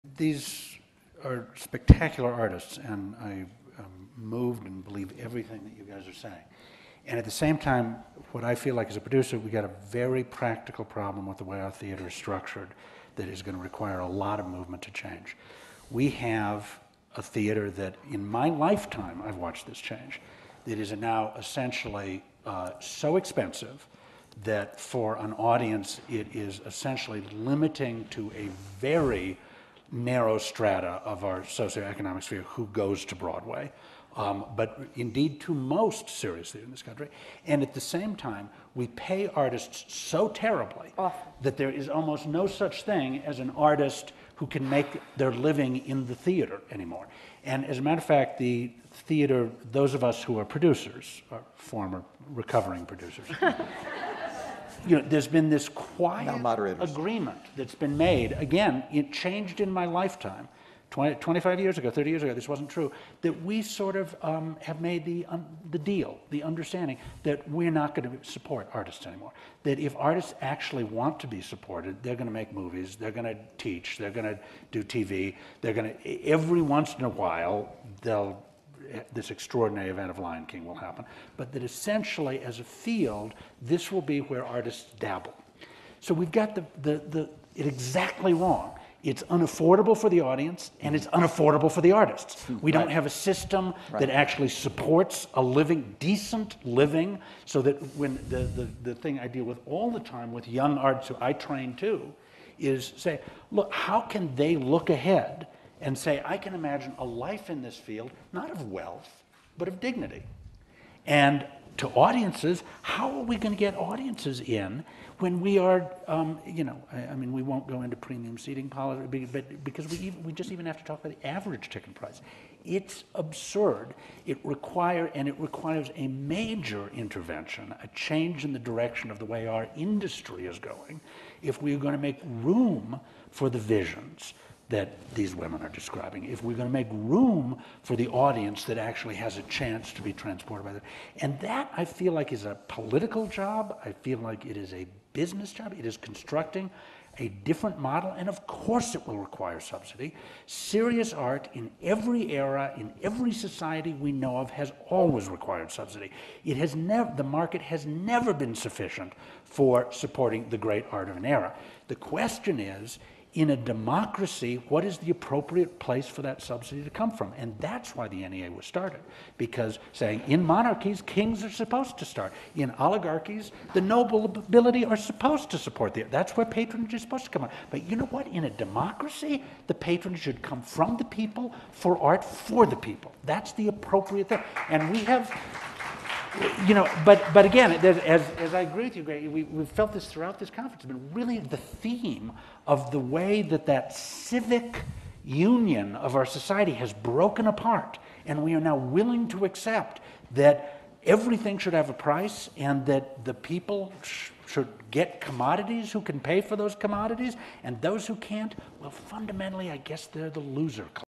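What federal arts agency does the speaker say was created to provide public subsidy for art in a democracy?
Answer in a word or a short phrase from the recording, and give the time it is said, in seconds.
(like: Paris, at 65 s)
NEA, at 168 s.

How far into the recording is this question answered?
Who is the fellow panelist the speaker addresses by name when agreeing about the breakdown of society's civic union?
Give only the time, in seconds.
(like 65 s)
189 s.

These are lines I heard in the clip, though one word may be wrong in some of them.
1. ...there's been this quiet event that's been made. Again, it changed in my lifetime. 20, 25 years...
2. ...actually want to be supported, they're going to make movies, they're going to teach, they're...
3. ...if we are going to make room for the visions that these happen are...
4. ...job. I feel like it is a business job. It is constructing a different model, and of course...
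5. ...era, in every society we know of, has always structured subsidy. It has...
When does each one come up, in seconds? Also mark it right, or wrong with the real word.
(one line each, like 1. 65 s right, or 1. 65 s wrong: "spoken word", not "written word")
1. 55 s wrong: "agreement", not "event"
2. 70 s right
3. 131 s wrong: "women", not "happen"
4. 143 s right
5. 152 s wrong: "required", not "structured".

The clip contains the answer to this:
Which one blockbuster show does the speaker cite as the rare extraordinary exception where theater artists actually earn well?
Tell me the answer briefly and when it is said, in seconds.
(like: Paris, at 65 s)
Lion King, at 80 s.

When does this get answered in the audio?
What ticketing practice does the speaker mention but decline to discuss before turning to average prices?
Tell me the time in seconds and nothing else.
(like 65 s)
117 s.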